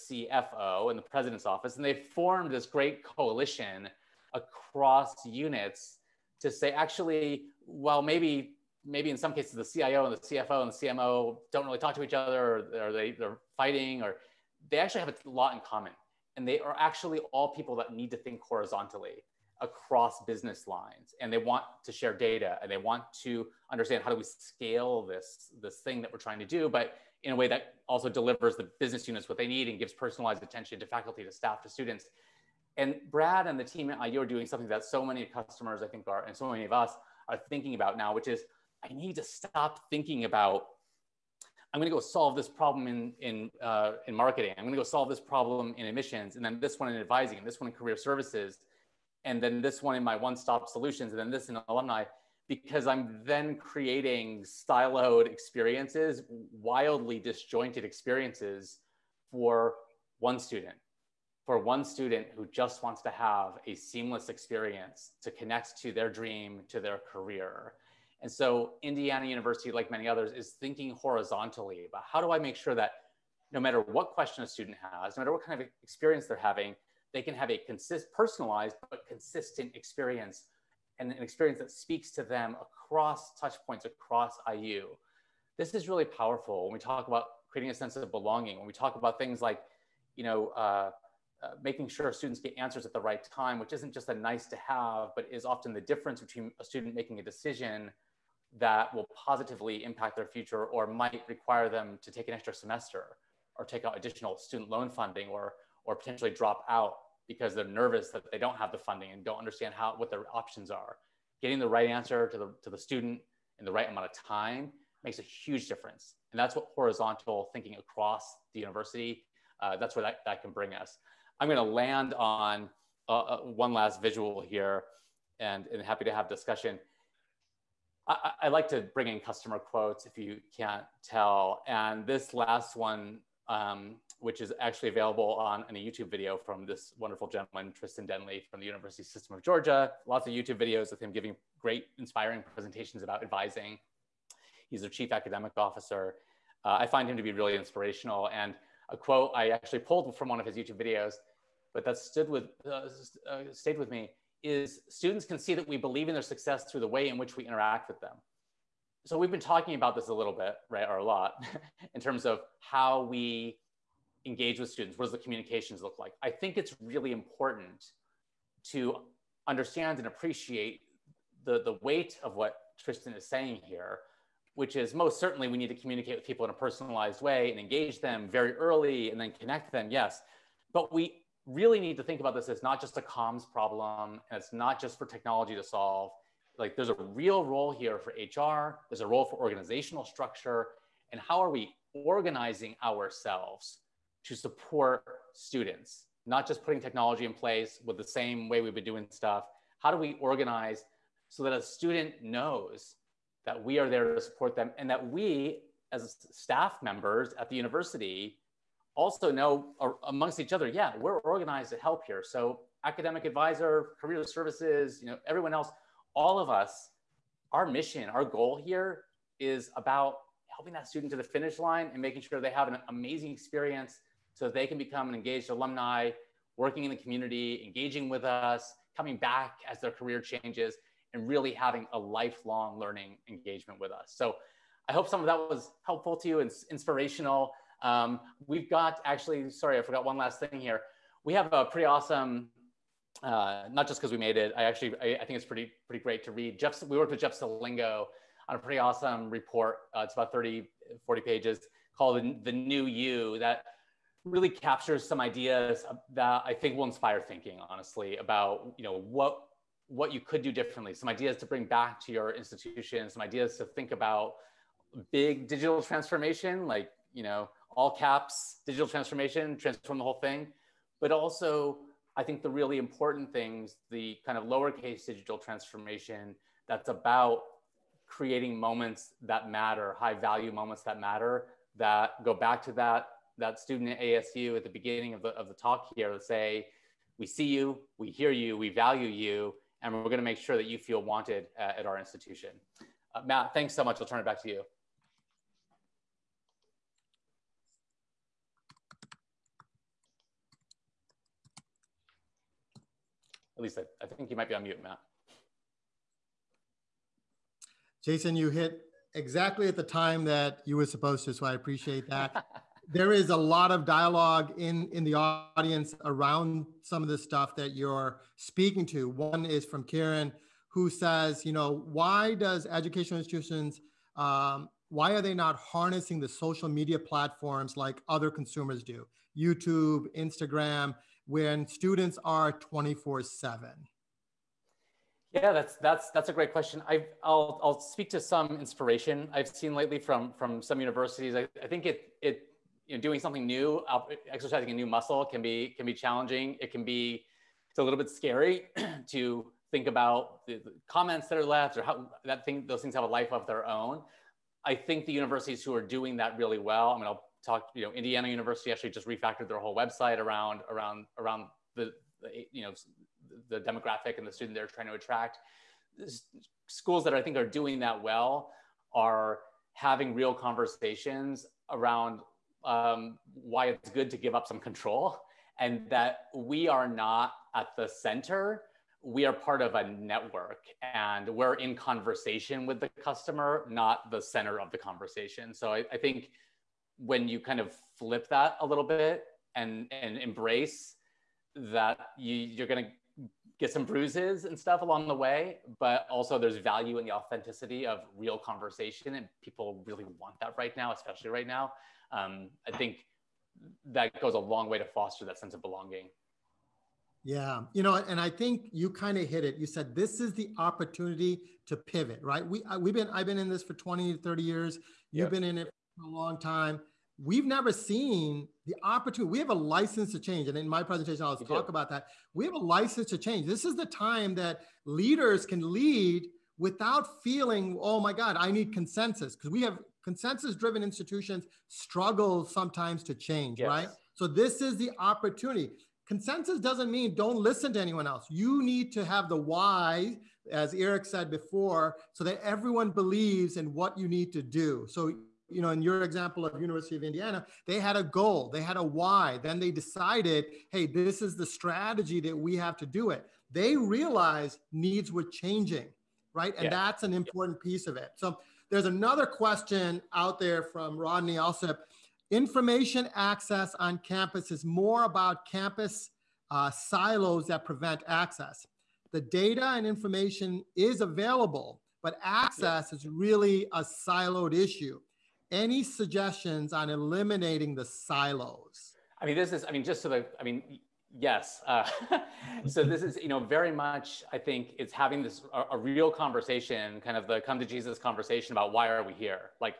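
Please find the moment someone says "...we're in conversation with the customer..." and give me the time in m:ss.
6:21.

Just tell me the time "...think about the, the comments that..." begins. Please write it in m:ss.
5:49.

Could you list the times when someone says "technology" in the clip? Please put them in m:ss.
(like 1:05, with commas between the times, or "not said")
3:05, 3:16.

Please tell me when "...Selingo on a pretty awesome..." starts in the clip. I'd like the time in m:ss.
4:07.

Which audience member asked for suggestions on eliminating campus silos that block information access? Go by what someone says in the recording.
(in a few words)
Rodney.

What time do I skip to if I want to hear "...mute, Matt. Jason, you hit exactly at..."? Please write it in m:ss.
5:04.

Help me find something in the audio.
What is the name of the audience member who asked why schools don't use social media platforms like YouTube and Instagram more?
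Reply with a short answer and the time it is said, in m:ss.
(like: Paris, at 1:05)
Karen, at 5:19.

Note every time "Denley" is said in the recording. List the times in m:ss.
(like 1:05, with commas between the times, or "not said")
2:18.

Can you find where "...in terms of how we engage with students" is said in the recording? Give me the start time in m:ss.
2:41.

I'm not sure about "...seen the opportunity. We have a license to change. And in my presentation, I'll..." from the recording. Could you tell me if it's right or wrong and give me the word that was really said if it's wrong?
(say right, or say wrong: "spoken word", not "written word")
right.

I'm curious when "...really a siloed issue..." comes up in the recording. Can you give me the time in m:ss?
7:53.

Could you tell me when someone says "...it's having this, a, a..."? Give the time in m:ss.
8:04.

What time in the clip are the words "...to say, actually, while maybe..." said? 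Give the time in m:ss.
0:06.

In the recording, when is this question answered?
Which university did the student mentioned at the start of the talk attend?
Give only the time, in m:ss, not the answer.
4:44.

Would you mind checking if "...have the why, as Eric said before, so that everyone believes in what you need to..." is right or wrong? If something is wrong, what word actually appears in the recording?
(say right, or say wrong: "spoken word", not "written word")
right.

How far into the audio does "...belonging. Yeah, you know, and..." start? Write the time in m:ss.
6:45.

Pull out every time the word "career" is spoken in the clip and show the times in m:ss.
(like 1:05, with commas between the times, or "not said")
0:47, 1:07, 3:34, 3:49.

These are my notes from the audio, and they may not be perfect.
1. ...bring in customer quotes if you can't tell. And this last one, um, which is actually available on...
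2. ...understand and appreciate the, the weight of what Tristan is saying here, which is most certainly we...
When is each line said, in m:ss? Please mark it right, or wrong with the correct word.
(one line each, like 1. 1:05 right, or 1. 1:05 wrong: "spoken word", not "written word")
1. 2:08 right
2. 2:49 right.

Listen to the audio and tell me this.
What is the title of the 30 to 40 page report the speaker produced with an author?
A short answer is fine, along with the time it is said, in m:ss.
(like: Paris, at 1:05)
The New You, at 4:12.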